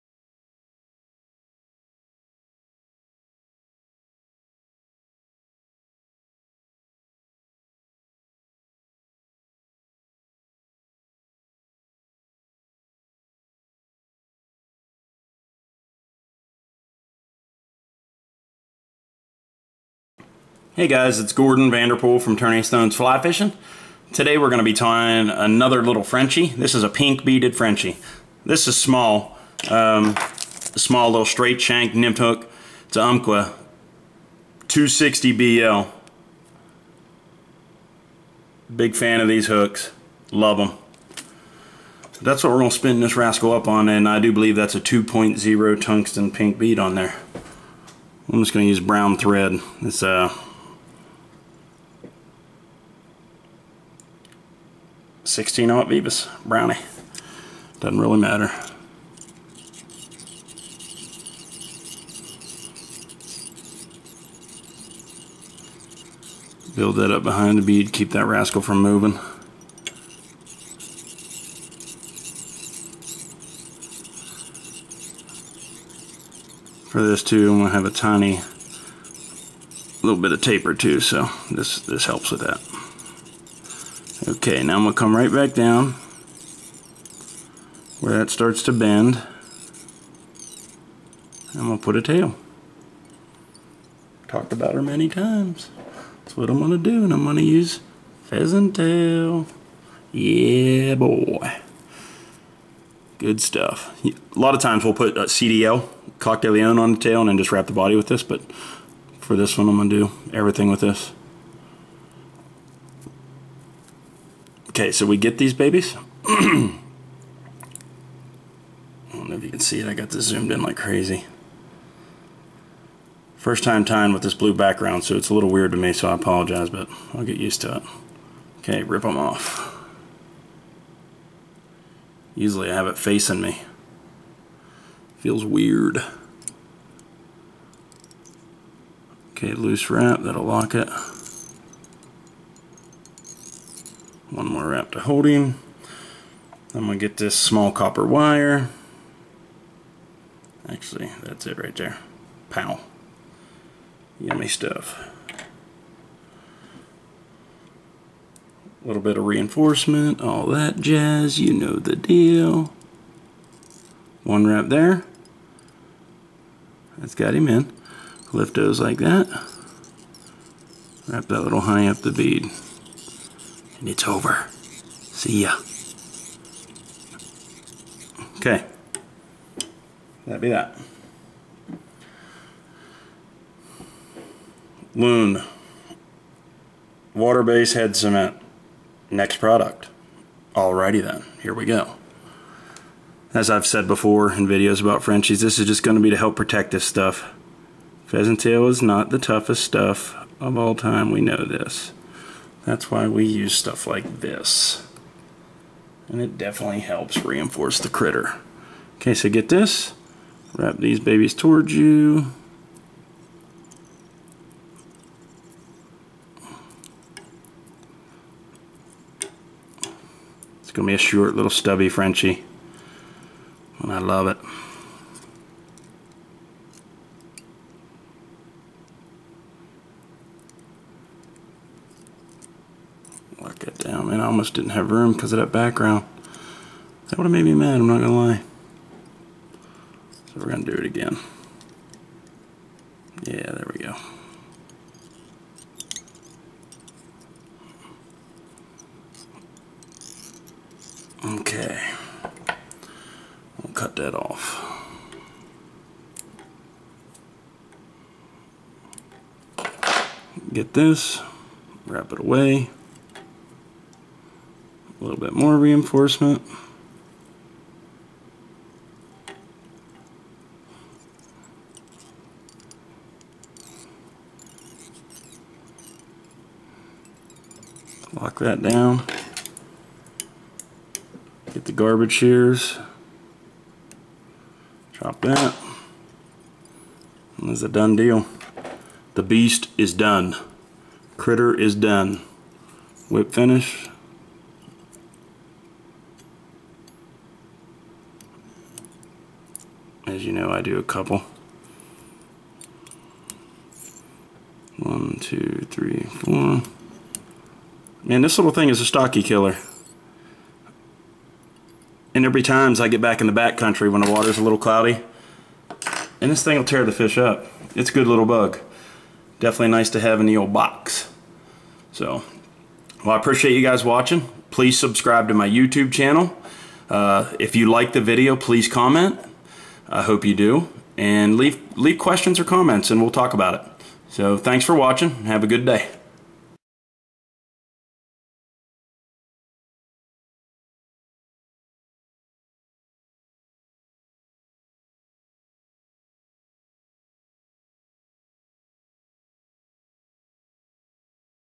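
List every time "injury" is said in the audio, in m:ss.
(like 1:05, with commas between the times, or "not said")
not said.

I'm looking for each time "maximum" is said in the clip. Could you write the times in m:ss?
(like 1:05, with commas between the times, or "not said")
not said.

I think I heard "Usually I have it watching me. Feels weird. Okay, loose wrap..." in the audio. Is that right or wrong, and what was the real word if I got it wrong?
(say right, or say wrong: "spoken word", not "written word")
wrong: "facing", not "watching".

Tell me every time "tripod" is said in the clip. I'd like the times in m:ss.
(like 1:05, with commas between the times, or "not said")
not said.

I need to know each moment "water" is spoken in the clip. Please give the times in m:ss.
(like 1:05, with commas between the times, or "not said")
3:07, 5:14.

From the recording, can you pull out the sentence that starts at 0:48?
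I'm just going to use brown thread.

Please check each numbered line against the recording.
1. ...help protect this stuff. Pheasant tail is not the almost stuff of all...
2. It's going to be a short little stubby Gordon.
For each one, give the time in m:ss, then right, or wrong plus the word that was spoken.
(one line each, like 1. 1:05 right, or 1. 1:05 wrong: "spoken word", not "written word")
1. 3:16 wrong: "toughest", not "almost"
2. 3:40 wrong: "Frenchie", not "Gordon".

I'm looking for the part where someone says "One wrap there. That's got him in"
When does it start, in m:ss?
2:44.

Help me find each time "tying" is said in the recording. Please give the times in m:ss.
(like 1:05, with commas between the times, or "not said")
0:24, 2:03.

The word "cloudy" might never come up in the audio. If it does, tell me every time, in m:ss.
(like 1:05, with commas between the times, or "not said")
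5:14.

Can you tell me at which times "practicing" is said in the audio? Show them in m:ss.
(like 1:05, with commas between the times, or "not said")
not said.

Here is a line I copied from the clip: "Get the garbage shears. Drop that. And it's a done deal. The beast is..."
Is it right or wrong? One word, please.
right.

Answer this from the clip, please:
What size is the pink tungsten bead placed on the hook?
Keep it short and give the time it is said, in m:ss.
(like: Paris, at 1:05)
2.0, at 0:44.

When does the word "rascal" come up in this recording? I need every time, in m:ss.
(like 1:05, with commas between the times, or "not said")
0:43, 1:08.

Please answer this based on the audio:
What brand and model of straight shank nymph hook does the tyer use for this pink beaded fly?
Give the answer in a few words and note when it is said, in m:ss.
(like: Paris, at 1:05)
Umpqua 260 BL, at 0:33.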